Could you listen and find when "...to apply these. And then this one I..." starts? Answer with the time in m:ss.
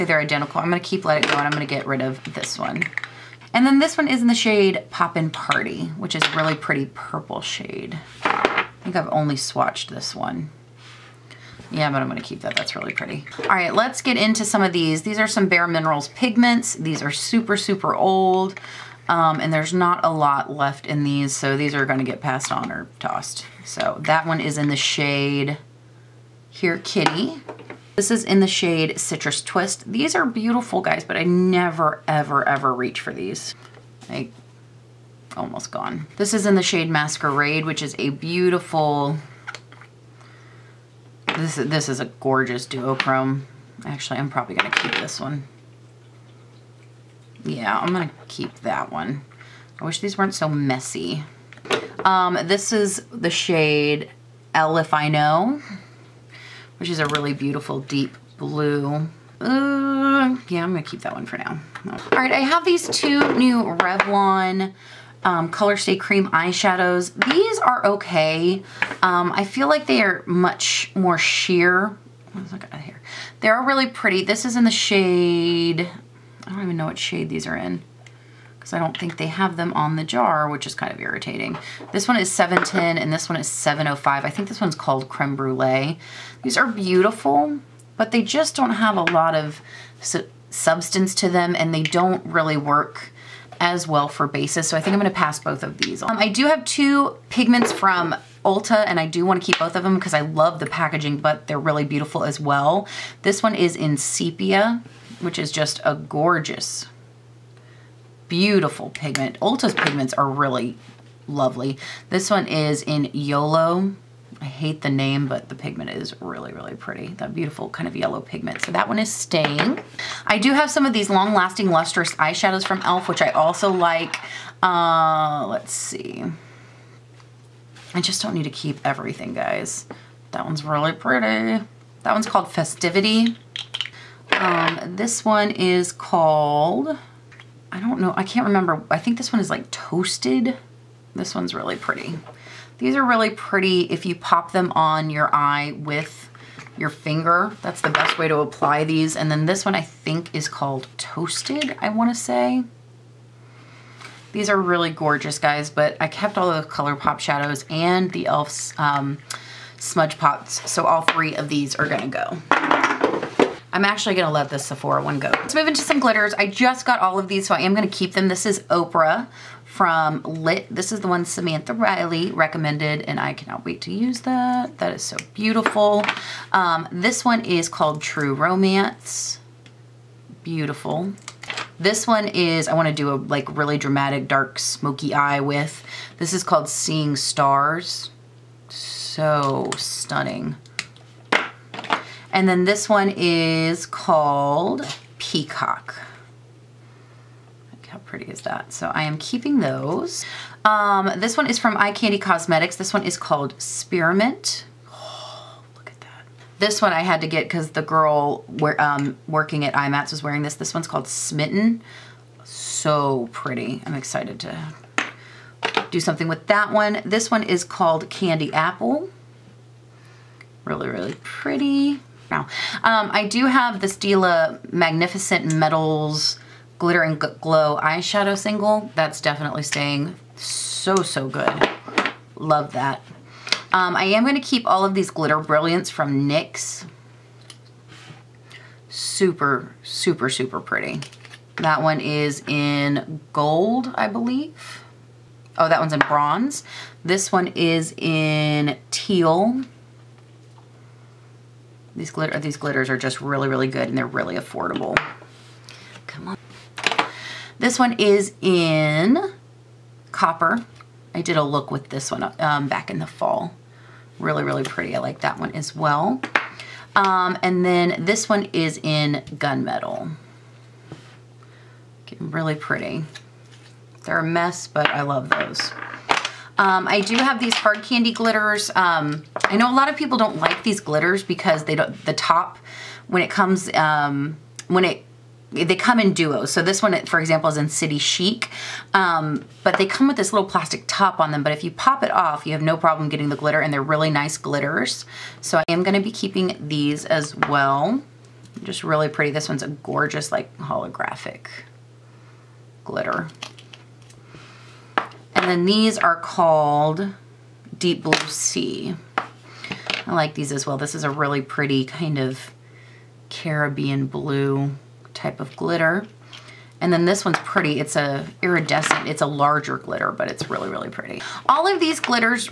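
2:28.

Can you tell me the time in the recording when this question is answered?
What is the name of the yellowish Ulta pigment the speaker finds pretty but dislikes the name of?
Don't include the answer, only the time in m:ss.
1:53.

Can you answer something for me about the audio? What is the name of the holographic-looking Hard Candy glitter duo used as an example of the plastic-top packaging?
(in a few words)
City Chic.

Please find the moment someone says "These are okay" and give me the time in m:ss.
1:07.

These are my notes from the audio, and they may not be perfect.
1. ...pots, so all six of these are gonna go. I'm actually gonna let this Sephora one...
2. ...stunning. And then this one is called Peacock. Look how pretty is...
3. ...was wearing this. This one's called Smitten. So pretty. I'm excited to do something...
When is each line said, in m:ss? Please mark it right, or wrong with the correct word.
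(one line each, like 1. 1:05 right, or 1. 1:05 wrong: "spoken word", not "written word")
1. 2:40 wrong: "three", not "six"
2. 3:09 right
3. 3:30 right.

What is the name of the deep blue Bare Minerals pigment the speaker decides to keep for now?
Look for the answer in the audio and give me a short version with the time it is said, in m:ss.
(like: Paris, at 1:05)
L If I Know, at 0:54.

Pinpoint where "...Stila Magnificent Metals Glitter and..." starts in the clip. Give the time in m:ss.
3:43.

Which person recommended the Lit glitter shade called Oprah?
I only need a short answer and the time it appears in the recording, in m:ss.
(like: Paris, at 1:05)
Samantha Riley, at 2:51.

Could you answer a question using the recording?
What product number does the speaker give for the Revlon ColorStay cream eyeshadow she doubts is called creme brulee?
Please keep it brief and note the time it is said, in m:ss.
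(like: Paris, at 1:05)
710, at 1:22.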